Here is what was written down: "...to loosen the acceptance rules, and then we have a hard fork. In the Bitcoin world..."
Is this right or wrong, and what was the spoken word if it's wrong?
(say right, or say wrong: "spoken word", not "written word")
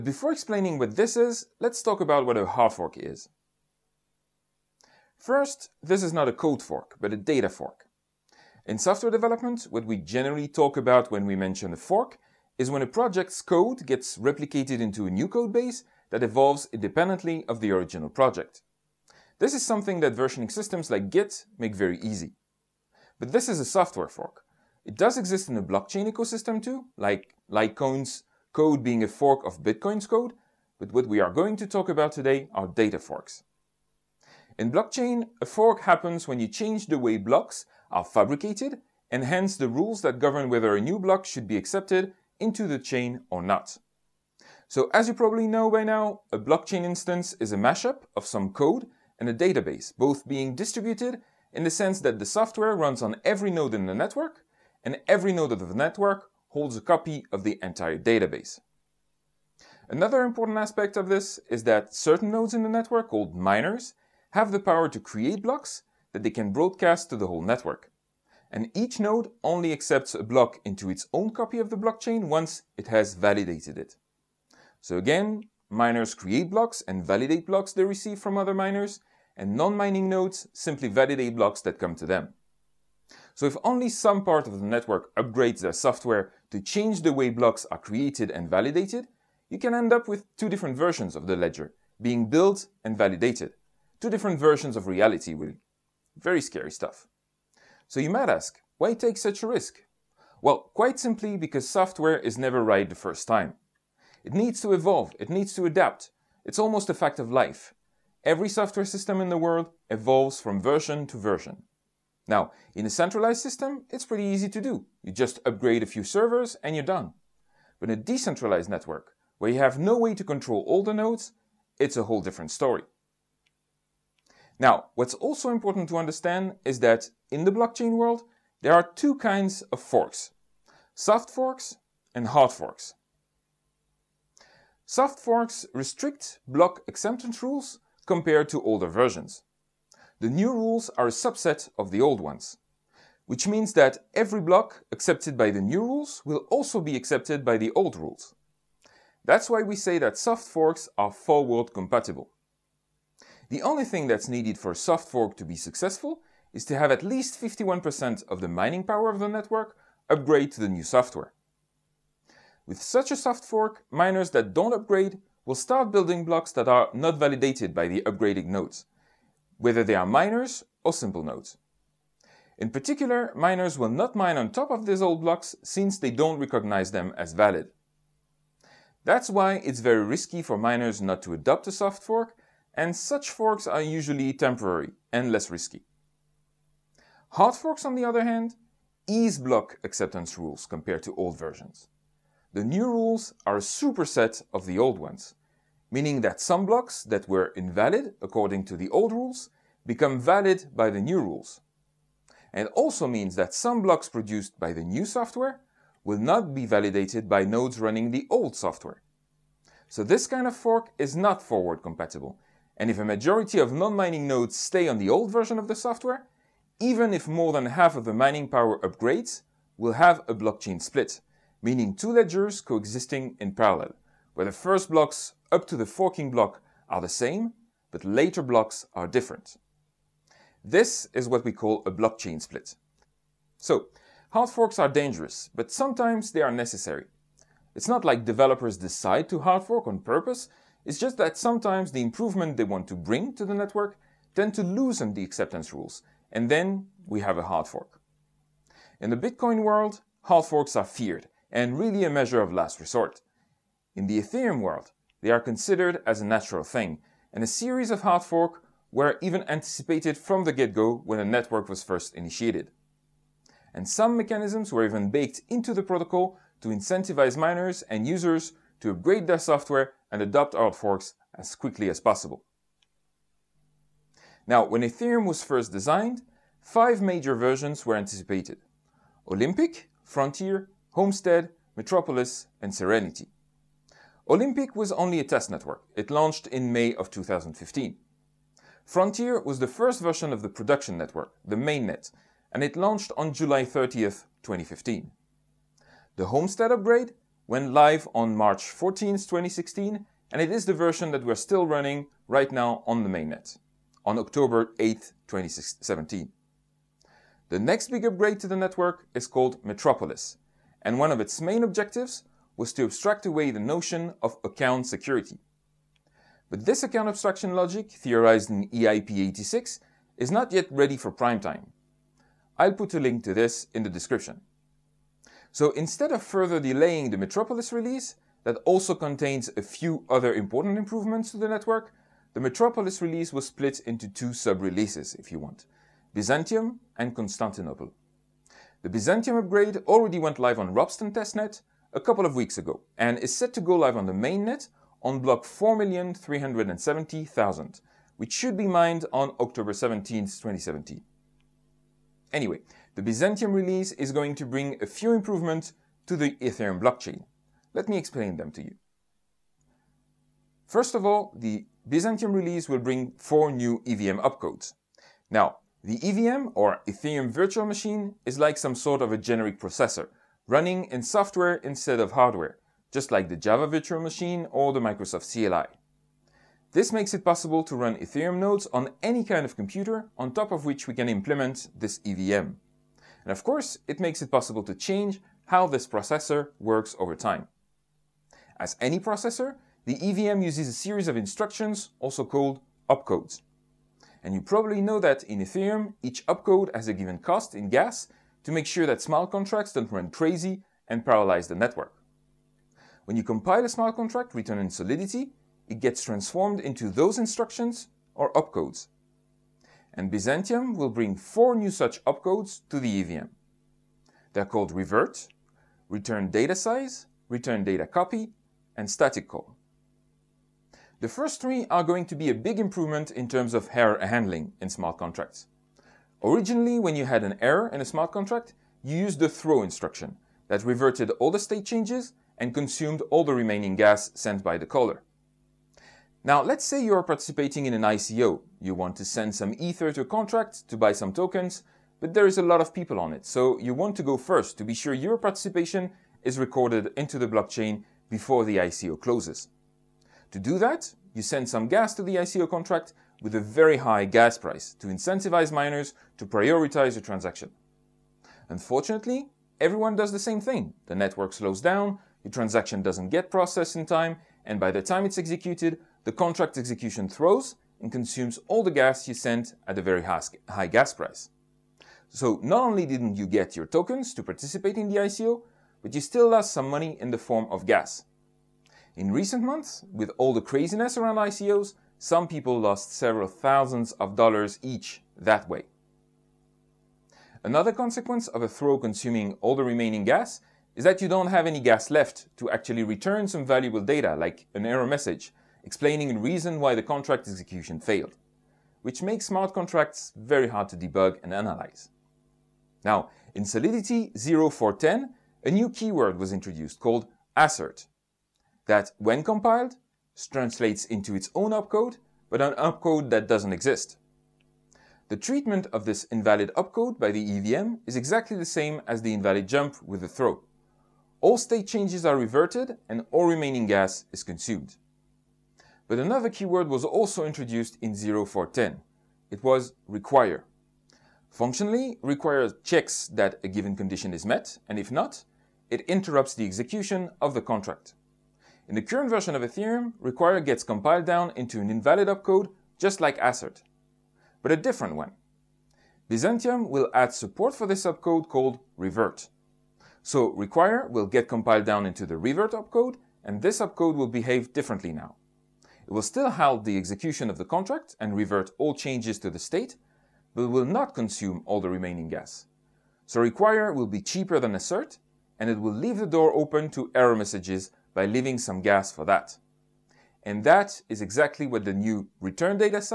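right.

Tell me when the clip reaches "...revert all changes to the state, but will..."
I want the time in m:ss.
9:18.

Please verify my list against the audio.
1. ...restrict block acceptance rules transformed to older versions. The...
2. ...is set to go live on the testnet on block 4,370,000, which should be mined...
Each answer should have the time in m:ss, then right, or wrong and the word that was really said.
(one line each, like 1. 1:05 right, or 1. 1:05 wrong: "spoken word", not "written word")
1. 2:15 wrong: "compared", not "transformed"
2. 5:43 wrong: "mainnet", not "testnet".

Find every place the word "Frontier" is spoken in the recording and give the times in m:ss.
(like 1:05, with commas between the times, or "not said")
4:40, 4:48.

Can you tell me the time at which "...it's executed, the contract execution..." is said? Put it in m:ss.
7:45.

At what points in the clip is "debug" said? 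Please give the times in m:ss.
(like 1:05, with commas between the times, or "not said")
8:20.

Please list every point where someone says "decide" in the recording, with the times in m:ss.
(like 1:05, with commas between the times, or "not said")
3:58.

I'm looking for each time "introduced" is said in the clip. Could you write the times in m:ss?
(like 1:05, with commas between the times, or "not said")
8:26, 8:47.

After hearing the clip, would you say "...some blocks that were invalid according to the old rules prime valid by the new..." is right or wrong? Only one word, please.
wrong.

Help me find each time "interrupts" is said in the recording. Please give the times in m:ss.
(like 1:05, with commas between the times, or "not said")
8:55.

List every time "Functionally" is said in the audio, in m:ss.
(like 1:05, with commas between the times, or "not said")
8:51.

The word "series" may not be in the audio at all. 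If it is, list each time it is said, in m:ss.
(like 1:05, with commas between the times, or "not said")
4:17, 6:30.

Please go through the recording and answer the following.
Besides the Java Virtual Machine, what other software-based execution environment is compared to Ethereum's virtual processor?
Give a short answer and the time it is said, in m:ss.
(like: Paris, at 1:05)
Microsoft CLI, at 6:14.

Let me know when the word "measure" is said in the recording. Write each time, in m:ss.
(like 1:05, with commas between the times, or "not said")
4:12.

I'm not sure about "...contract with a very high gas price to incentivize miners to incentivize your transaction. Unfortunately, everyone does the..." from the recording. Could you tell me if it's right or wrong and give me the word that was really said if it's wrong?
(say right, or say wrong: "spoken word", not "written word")
wrong: "prioritize", not "incentivize".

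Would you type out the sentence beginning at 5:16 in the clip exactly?
But this account abstraction logic, theorized in EIP 86, is not yet ready for prime time.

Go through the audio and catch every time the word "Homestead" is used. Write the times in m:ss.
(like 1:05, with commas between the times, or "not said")
4:40, 4:56.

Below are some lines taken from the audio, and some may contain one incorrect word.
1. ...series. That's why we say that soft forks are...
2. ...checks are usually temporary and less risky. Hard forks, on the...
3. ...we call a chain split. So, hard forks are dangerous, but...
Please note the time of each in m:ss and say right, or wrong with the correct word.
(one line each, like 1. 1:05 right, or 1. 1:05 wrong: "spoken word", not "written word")
1. 2:27 wrong: "rules", not "series"
2. 3:03 wrong: "forks", not "checks"
3. 3:51 wrong: "blockchain", not "chain".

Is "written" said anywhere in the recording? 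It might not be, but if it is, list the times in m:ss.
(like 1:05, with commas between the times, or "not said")
6:44.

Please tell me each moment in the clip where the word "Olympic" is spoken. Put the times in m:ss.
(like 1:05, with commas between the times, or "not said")
4:39, 4:44.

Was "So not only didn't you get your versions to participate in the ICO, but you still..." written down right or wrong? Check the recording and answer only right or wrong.
wrong.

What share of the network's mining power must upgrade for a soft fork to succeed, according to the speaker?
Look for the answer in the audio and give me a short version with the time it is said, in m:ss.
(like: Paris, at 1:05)
51%, at 2:37.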